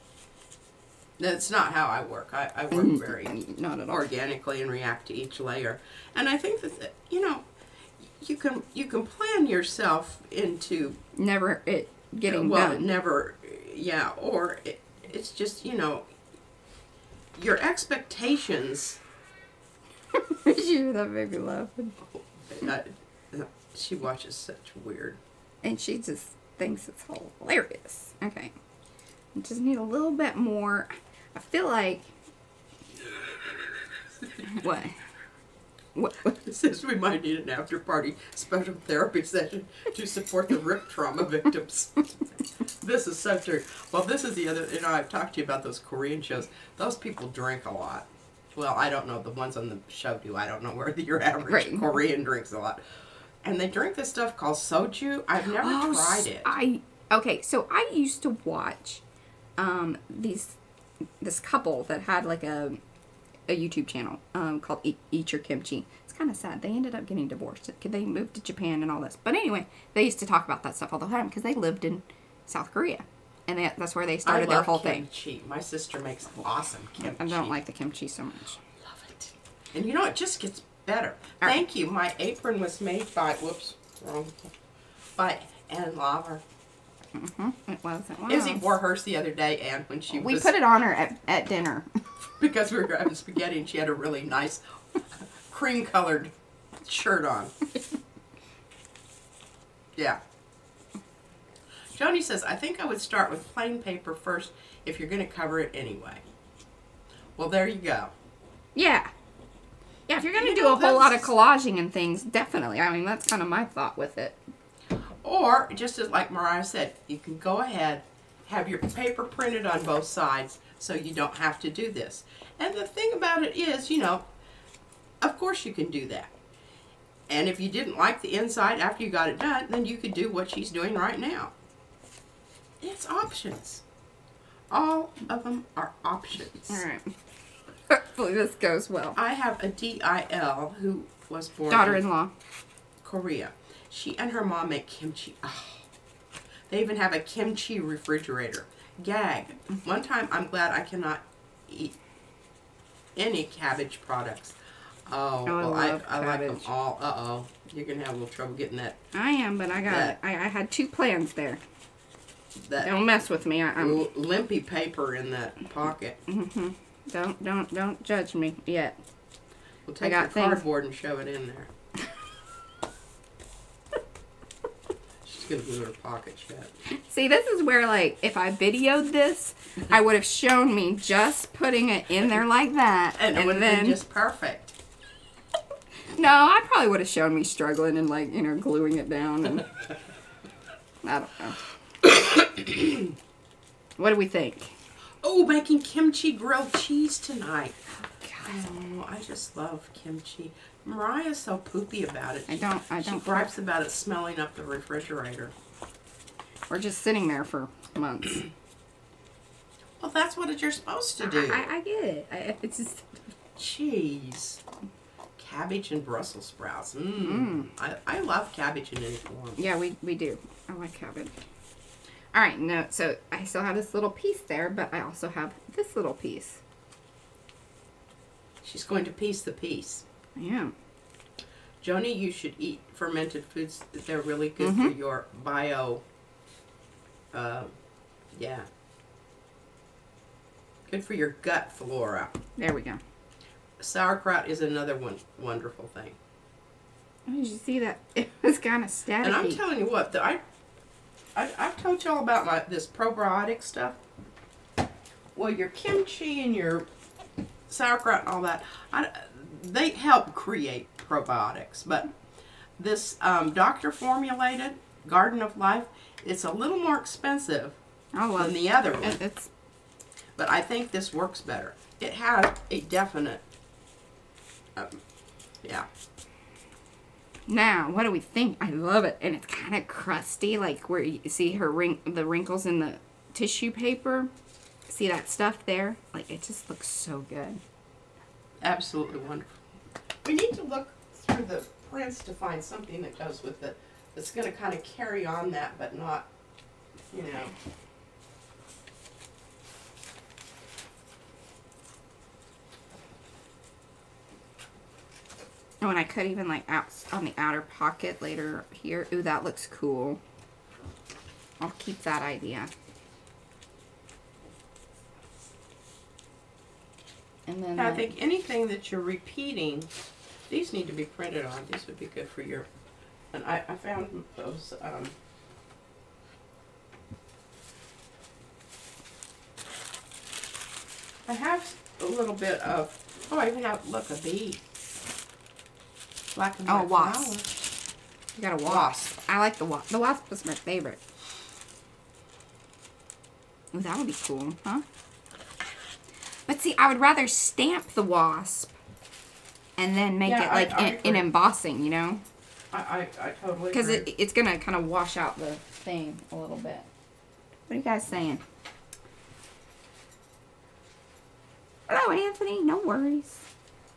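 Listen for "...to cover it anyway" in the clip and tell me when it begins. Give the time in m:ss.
1:45.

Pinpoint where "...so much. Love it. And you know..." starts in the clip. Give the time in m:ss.
1:18.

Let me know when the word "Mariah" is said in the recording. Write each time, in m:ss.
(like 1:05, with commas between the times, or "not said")
1:56, 3:20.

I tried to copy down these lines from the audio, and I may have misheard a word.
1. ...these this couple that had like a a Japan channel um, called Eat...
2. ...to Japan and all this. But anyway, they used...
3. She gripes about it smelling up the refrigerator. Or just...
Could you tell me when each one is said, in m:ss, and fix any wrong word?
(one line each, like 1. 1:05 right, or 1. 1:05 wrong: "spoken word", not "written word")
1. 1:00 wrong: "YouTube", not "Japan"
2. 1:08 right
3. 3:23 right.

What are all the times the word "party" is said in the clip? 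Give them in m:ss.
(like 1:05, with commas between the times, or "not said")
0:37.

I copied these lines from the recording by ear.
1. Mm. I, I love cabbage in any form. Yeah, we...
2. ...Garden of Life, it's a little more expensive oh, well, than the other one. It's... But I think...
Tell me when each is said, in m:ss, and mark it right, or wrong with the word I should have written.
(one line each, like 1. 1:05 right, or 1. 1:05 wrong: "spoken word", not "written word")
1. 3:37 right
2. 4:25 right.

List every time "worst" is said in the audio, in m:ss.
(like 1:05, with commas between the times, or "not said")
not said.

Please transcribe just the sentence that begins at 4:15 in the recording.
Well, your kimchi and your sauerkraut and all that.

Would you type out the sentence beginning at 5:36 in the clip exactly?
Black and oh, white oh, wasp.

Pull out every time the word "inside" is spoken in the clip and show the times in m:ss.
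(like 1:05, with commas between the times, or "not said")
2:08.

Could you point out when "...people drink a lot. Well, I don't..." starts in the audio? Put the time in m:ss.
0:46.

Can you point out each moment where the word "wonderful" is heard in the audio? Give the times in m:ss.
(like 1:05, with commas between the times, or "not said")
4:05, 4:49.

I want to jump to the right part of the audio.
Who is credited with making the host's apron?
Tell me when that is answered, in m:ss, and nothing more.
1:25.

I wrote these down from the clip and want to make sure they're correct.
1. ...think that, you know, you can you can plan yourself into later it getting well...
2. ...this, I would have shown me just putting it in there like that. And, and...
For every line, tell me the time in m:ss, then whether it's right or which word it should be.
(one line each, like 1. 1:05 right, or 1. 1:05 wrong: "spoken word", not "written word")
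1. 0:06 wrong: "never", not "later"
2. 2:59 right.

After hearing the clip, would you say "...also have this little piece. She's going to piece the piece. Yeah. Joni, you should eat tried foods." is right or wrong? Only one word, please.
wrong.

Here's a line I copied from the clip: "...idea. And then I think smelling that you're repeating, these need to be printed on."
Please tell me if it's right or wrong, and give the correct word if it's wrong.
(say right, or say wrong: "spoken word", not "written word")
wrong: "anything", not "smelling".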